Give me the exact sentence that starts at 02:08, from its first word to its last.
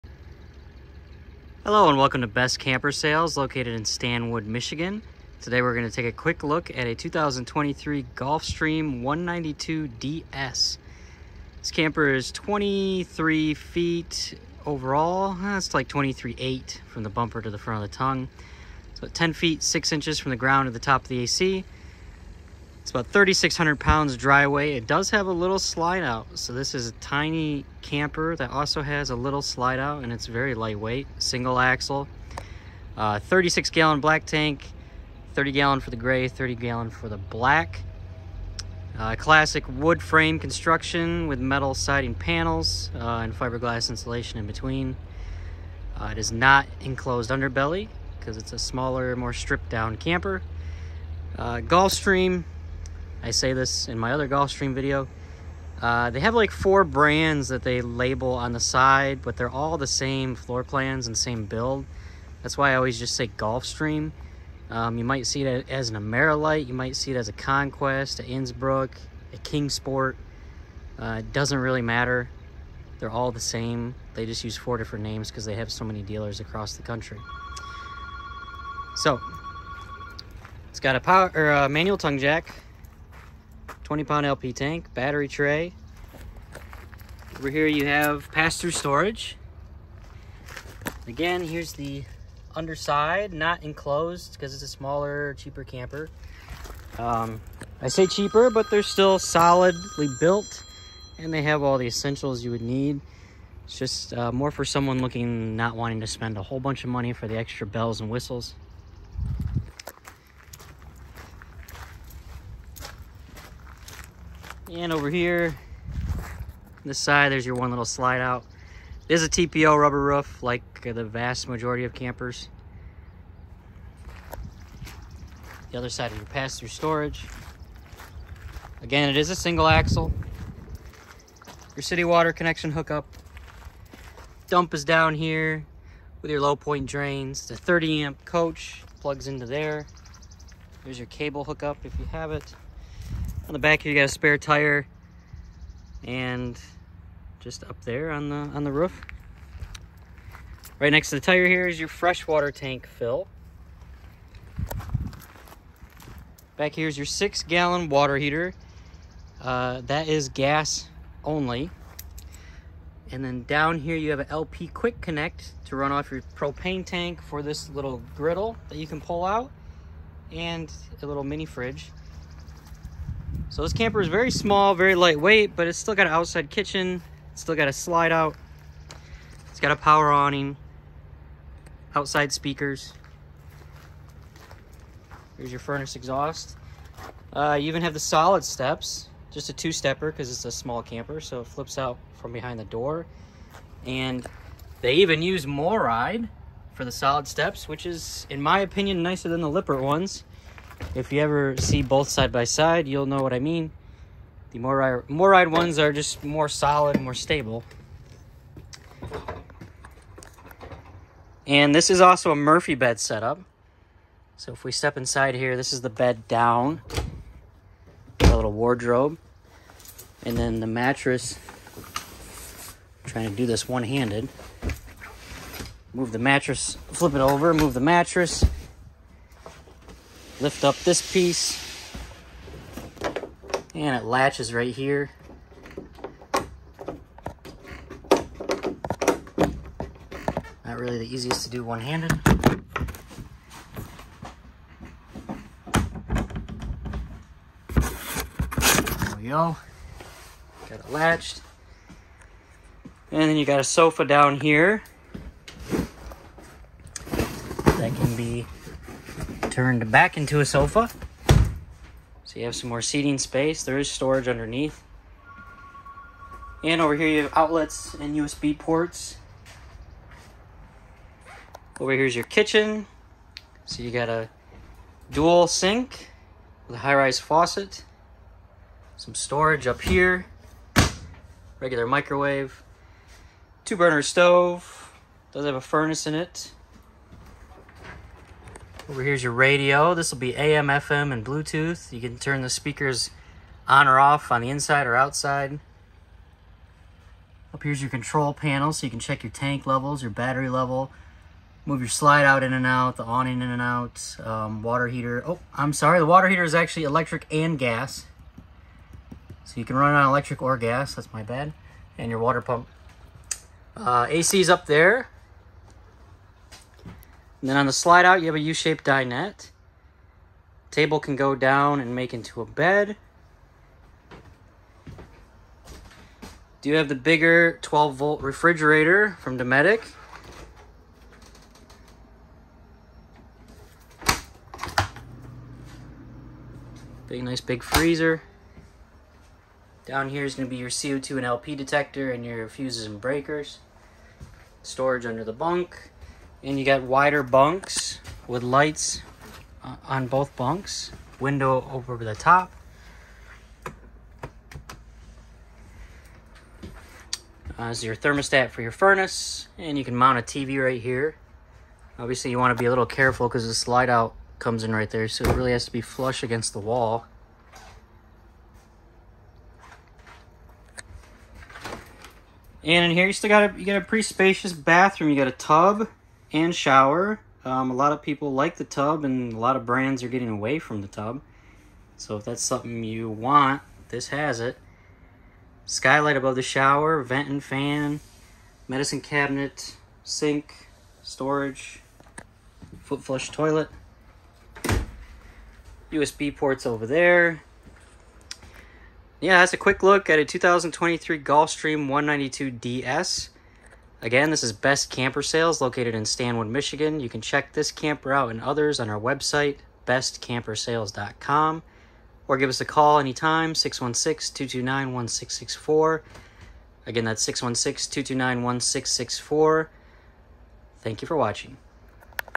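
Again, it is a single axle.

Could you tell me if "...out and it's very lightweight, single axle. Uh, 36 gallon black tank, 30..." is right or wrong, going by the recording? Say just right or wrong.
right.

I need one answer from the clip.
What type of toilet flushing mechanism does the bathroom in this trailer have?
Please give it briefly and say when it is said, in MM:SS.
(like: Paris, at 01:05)
foot flush, at 06:32.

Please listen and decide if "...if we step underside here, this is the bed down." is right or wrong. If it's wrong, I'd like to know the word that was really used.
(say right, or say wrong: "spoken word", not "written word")
wrong: "inside", not "underside".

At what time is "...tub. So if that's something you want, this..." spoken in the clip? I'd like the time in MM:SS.
06:20.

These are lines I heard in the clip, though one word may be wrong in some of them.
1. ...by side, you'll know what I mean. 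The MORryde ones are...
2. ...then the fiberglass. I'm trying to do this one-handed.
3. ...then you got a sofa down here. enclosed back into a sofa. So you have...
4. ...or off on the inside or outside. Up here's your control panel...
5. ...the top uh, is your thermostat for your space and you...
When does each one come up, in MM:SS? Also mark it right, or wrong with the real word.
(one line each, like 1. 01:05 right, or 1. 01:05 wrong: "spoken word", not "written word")
1. 03:22 right
2. 03:40 wrong: "mattress", not "fiberglass"
3. 04:13 wrong: "turned", not "enclosed"
4. 04:53 right
5. 05:51 wrong: "furnace", not "space".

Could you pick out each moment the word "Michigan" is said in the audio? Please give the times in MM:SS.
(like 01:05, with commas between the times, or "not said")
00:04, 06:46.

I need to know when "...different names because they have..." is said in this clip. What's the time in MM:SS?
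01:14.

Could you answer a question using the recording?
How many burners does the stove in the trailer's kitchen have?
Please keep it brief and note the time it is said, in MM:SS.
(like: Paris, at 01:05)
2, at 04:43.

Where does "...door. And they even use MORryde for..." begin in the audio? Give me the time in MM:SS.
03:12.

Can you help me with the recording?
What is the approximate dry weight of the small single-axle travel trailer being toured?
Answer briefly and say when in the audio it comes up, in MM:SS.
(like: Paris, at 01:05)
3,600 pounds, at 00:23.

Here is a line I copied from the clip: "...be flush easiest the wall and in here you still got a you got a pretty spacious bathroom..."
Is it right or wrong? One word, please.
wrong.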